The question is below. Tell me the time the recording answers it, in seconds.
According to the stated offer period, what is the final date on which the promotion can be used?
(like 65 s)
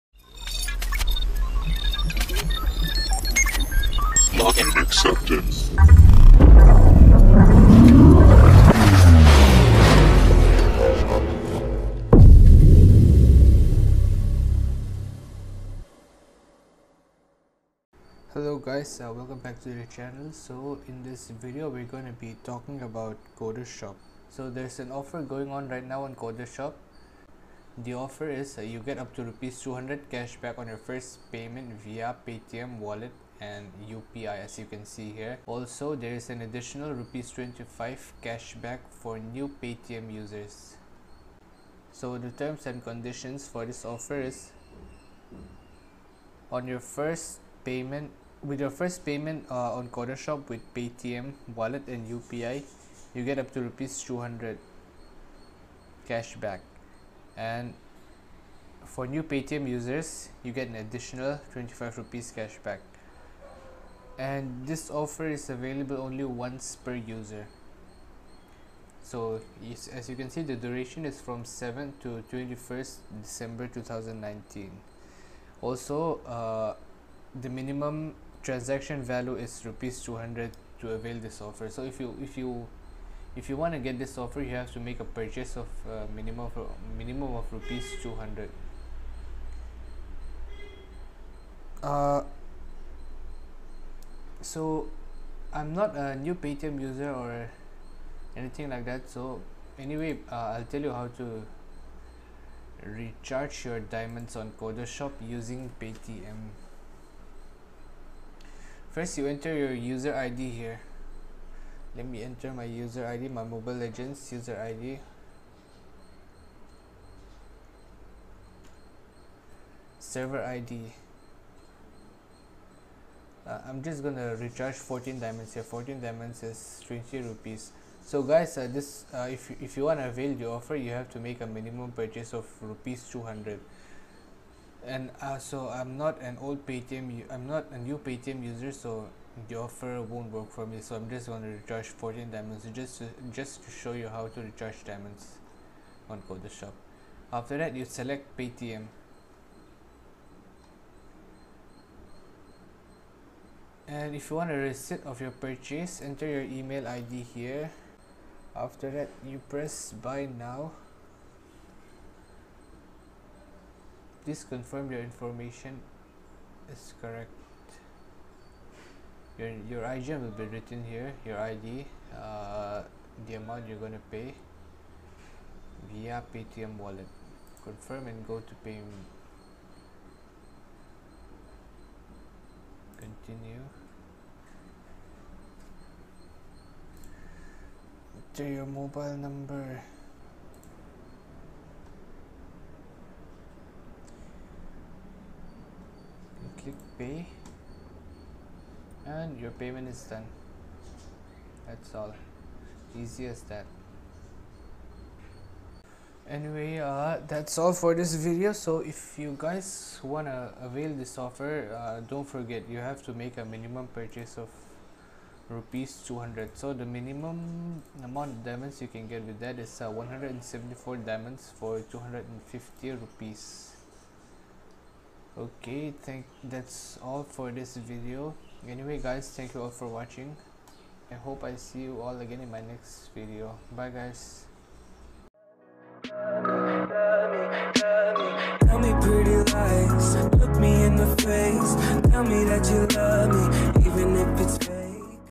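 72 s.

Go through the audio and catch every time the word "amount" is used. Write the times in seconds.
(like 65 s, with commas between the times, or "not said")
173 s, 218 s.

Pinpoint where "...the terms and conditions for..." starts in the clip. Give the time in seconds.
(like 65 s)
42 s.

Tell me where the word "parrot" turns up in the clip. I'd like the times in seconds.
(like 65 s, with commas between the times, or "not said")
not said.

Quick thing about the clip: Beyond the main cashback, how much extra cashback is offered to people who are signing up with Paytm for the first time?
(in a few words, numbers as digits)
25 rupees.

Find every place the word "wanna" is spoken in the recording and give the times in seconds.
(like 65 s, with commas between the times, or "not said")
210 s.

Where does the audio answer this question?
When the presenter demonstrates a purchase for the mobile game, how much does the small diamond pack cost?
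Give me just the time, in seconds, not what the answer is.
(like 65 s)
126 s.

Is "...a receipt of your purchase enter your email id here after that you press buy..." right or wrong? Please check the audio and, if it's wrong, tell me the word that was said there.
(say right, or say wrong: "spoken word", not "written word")
right.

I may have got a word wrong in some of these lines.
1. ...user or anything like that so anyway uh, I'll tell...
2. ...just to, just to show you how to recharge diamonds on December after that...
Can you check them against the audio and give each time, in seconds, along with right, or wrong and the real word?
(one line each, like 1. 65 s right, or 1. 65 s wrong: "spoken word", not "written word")
1. 96 s right
2. 142 s wrong: "Codashop", not "December".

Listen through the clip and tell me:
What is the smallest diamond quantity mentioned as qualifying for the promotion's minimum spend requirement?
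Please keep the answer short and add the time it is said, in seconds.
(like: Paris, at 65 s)
174 diamonds, at 219 s.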